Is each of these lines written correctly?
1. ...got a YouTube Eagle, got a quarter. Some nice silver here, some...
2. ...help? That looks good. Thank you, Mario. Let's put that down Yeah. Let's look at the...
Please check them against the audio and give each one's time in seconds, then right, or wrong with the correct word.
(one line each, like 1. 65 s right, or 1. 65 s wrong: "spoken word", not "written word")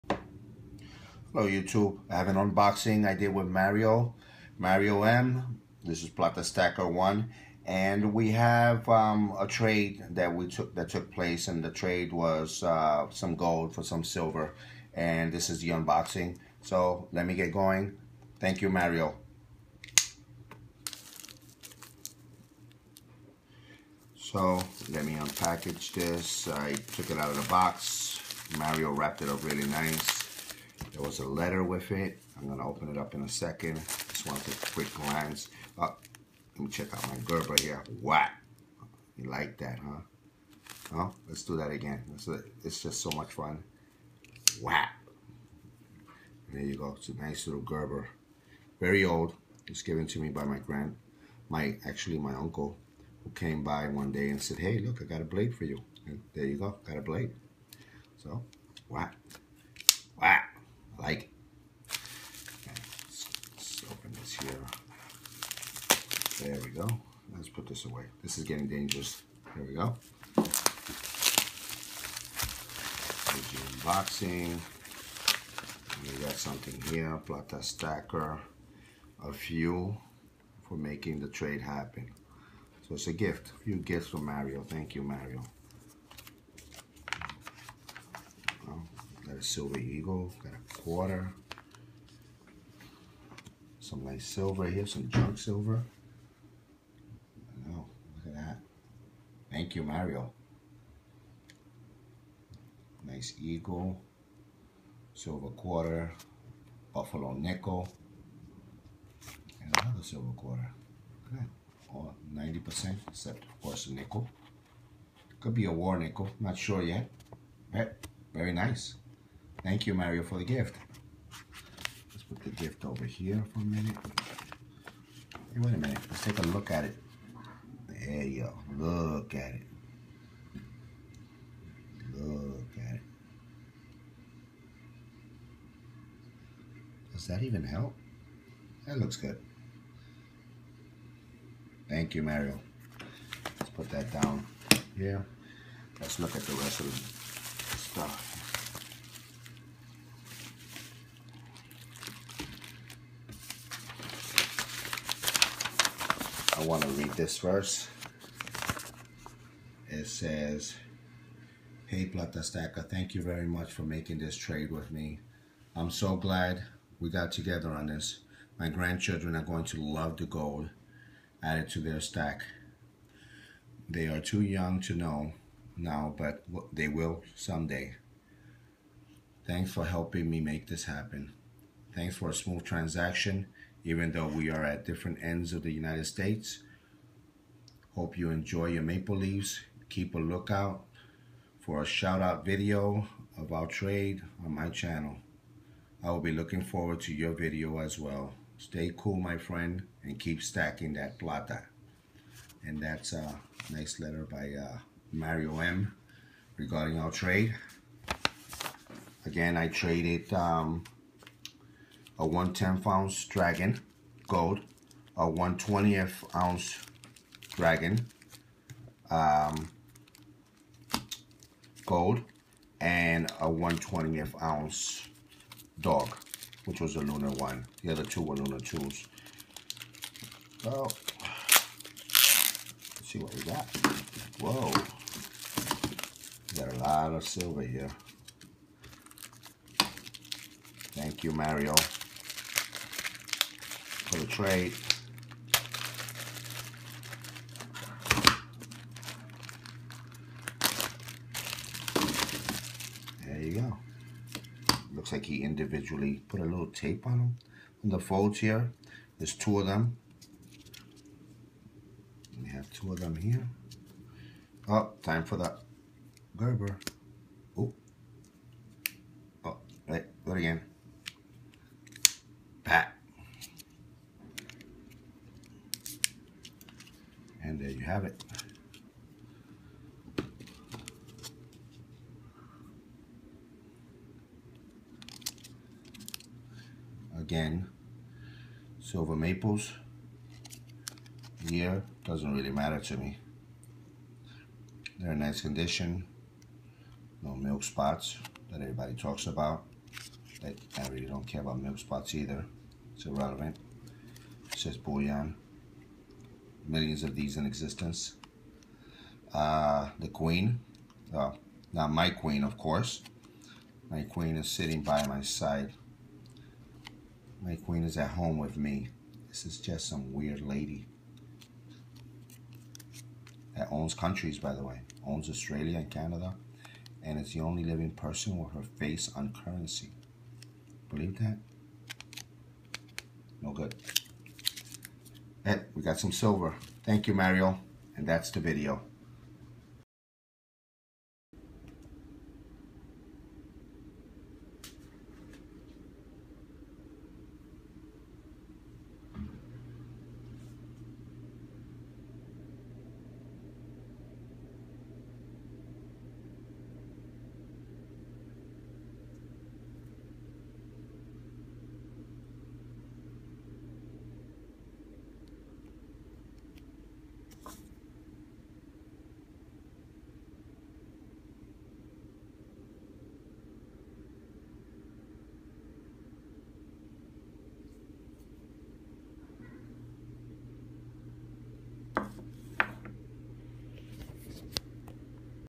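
1. 89 s wrong: "Silver", not "YouTube"
2. 137 s right.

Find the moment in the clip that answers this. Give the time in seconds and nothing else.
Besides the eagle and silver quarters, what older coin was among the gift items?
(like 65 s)
106 s.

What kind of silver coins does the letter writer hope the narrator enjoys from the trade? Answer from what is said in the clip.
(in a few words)
Maple leaves.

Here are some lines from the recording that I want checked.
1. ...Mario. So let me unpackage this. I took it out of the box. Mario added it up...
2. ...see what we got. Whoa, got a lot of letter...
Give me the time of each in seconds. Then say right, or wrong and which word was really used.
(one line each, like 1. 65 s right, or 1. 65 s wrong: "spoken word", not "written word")
1. 18 s wrong: "wrapped", not "added"
2. 233 s wrong: "silver", not "letter".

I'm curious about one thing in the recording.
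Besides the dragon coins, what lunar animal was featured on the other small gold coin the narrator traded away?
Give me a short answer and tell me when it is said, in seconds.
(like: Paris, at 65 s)
Dog, at 225 s.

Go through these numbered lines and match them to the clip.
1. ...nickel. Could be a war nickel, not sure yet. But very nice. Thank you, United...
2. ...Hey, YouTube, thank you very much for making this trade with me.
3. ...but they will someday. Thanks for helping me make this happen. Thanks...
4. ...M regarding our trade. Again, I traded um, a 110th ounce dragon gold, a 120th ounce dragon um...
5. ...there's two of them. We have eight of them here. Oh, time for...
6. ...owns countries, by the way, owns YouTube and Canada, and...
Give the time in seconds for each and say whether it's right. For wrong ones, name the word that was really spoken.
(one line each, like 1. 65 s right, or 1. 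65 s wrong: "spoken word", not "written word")
1. 113 s wrong: "Mario", not "United"
2. 161 s wrong: "PlataStacker", not "YouTube"
3. 176 s right
4. 205 s right
5. 259 s wrong: "two", not "eight"
6. 323 s wrong: "Australia", not "YouTube".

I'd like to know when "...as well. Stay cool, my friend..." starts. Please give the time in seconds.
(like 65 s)
197 s.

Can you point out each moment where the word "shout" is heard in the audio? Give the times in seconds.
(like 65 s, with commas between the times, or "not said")
191 s.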